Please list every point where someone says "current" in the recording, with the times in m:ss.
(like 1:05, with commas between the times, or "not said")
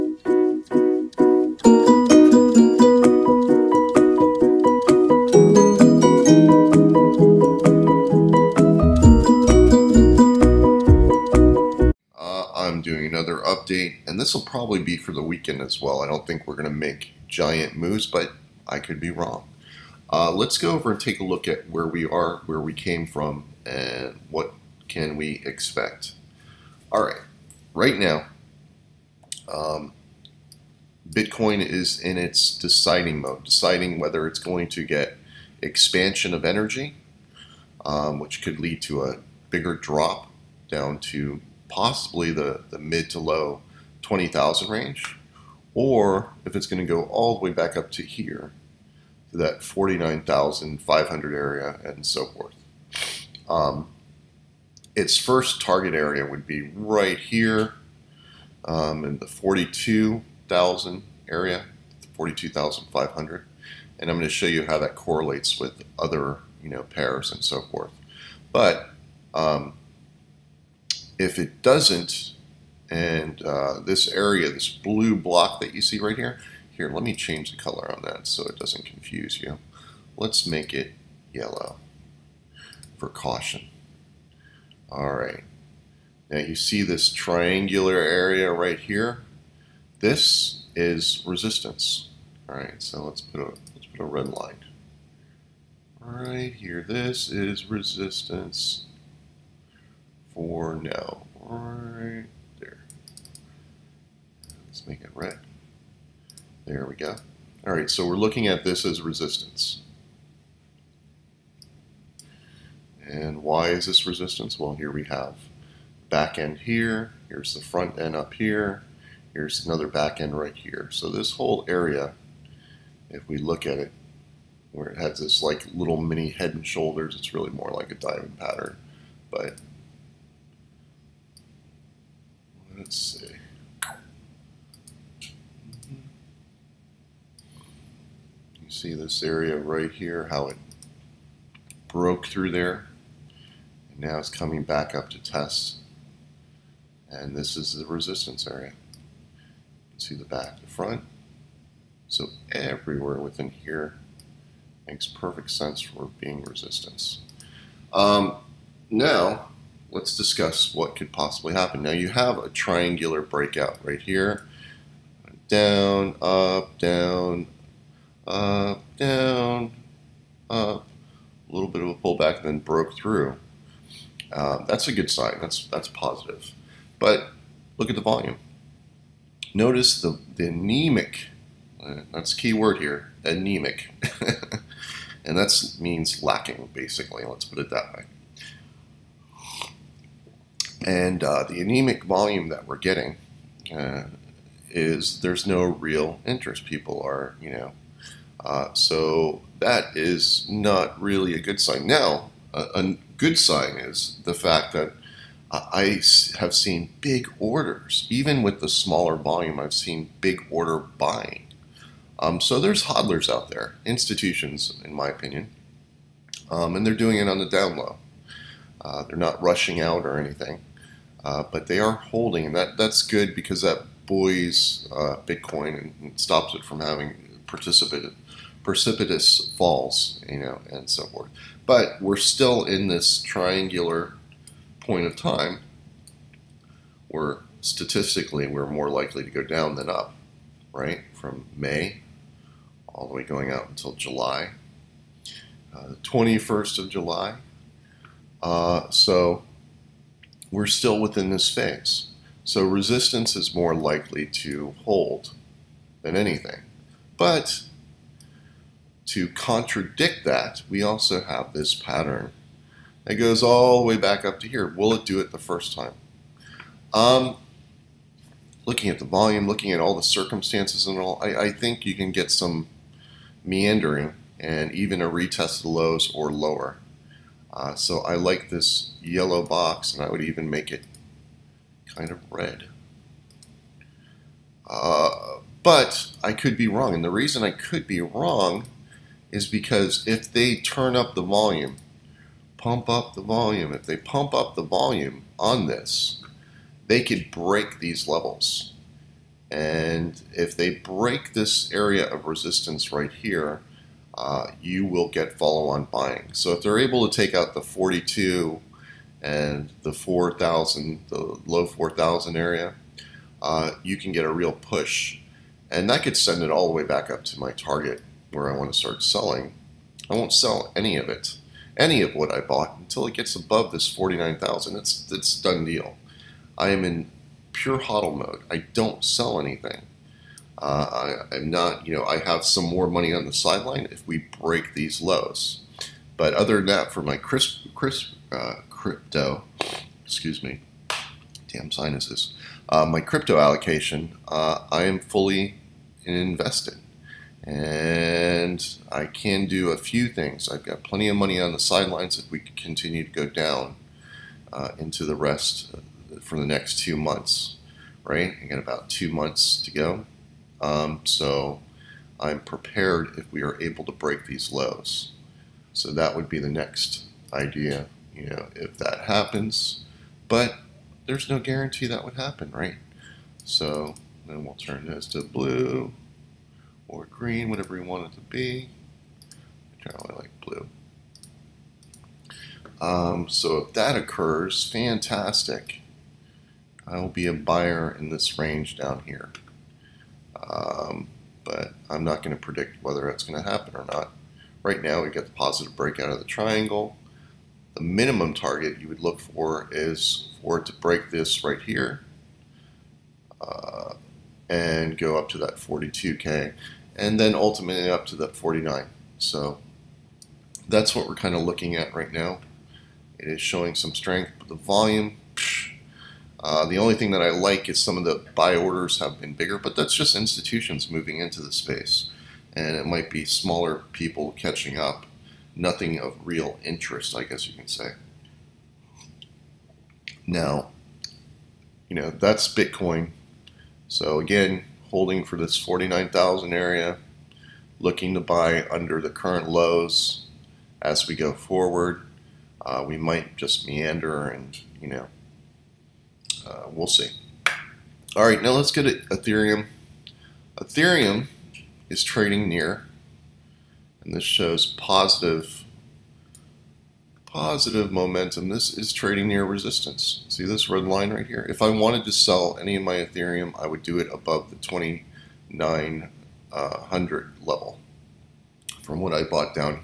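7:19.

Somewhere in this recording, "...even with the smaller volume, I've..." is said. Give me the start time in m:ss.
3:28.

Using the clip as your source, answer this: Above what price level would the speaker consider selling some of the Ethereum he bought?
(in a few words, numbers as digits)
2900.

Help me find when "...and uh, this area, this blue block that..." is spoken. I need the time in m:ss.
1:12.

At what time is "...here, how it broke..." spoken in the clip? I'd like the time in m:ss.
2:19.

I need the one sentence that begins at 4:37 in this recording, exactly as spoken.
Uh, so I like this yellow box, and I would even make it kind of red.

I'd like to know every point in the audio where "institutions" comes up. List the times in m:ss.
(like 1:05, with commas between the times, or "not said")
3:33, 7:00.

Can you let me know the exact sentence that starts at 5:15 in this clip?
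And that could send it all the way back up to my target where I want to start selling.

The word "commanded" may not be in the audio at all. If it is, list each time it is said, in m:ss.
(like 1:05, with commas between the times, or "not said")
not said.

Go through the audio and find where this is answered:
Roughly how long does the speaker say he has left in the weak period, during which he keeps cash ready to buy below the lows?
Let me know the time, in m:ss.
5:58.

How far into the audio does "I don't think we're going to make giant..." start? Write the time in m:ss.
0:16.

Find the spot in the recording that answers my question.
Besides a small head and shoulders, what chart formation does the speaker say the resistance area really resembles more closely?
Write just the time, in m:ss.
2:07.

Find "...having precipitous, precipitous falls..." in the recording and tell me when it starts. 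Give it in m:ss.
3:46.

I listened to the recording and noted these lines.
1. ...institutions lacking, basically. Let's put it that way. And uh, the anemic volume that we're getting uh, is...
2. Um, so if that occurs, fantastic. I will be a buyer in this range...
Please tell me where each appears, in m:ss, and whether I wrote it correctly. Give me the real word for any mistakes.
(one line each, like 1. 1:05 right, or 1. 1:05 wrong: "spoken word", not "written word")
1. 3:05 wrong: "means", not "institutions"
2. 6:22 right.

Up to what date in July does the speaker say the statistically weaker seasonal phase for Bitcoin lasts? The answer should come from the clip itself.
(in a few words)
July 21.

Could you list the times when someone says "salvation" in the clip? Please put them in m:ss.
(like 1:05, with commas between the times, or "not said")
not said.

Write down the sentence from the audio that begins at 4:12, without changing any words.
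So resistance is more likely to hold than anything.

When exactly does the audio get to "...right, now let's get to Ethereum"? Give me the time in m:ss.
7:28.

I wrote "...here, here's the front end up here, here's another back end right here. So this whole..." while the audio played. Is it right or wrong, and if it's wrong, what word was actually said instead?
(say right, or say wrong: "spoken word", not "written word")
right.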